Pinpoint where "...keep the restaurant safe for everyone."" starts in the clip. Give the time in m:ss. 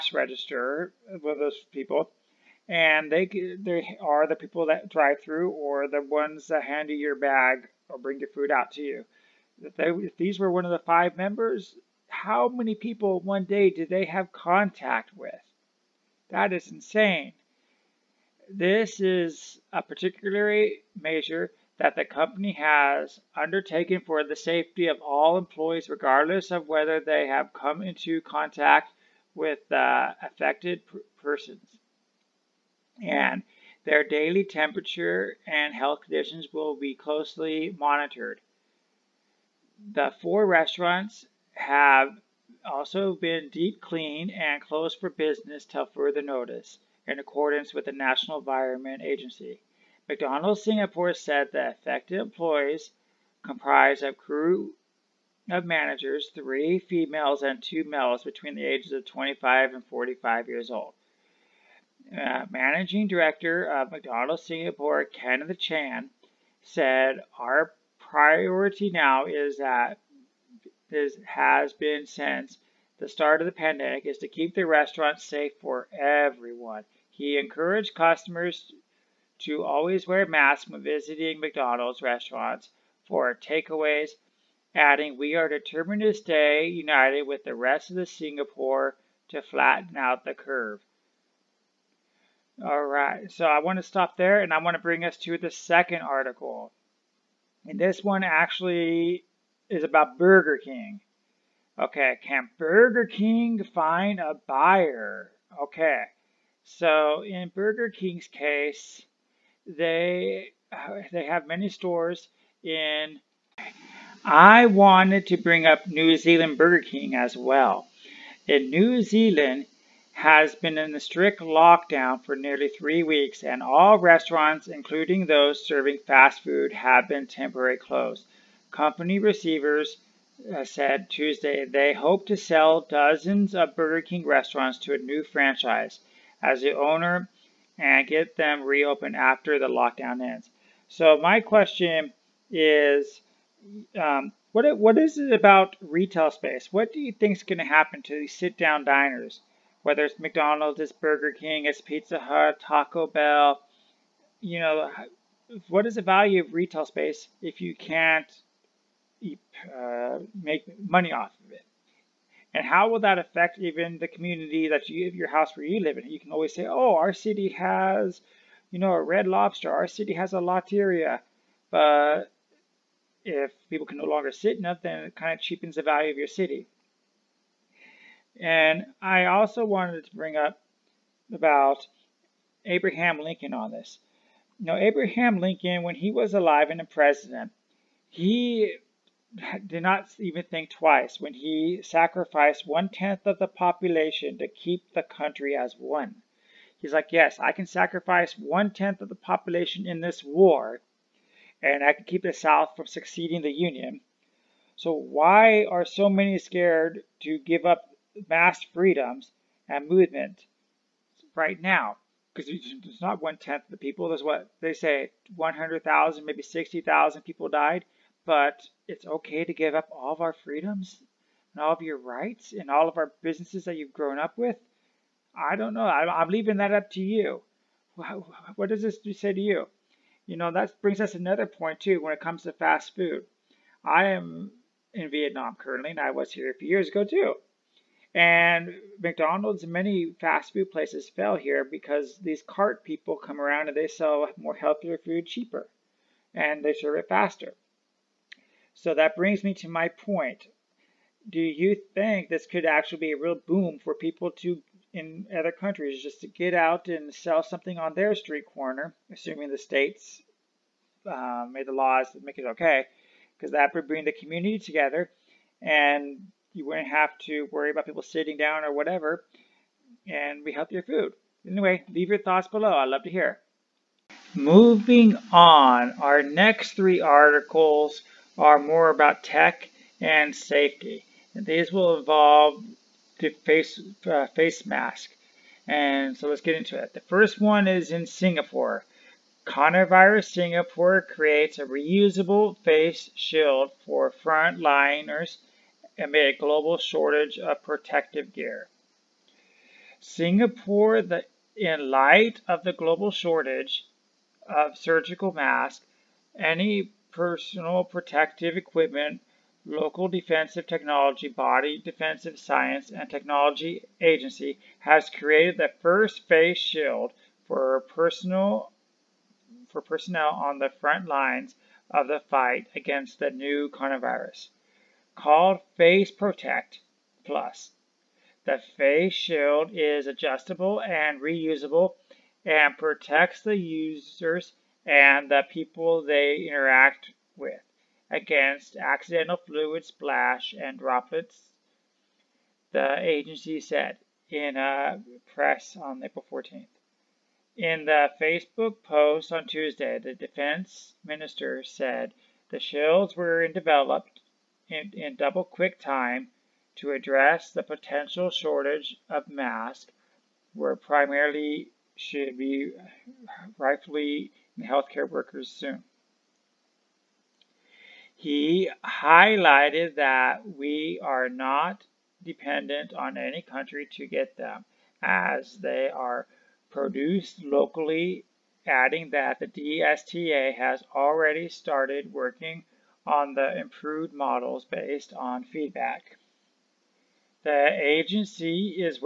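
1:14.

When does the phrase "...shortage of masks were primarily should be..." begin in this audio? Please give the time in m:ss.
5:58.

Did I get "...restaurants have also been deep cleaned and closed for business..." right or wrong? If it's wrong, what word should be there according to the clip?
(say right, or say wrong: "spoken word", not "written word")
right.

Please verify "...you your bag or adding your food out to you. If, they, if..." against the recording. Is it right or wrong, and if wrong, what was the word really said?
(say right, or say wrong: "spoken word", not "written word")
wrong: "bring", not "adding".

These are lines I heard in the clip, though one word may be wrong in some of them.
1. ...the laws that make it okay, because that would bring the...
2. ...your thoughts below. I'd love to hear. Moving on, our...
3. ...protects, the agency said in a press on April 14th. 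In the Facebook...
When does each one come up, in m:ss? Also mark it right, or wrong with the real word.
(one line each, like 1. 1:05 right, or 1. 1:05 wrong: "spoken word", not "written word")
1. 4:21 right
2. 4:32 right
3. 5:40 wrong: "droplets", not "protects".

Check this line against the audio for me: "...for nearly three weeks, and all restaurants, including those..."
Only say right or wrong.
right.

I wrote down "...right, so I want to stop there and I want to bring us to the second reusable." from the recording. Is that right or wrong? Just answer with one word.
wrong.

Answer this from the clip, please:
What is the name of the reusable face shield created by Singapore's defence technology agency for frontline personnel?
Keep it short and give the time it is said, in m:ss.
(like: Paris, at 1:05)
Face Protect Plus, at 5:25.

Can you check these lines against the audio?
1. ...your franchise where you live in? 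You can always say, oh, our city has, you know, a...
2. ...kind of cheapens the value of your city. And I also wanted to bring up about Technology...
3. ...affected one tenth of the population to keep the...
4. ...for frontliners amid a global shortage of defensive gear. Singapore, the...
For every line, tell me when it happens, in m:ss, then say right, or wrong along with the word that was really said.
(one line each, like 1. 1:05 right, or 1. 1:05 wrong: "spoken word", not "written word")
1. 2:45 wrong: "house", not "franchise"
2. 2:55 wrong: "Abraham", not "Technology"
3. 3:11 wrong: "sacrificed", not "affected"
4. 4:53 wrong: "protective", not "defensive".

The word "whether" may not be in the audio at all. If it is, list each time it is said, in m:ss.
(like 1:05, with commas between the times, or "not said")
0:26, 2:29.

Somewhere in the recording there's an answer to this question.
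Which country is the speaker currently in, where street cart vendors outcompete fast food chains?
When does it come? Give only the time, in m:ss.
3:55.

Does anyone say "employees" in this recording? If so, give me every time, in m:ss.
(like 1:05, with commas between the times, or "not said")
0:25, 0:52.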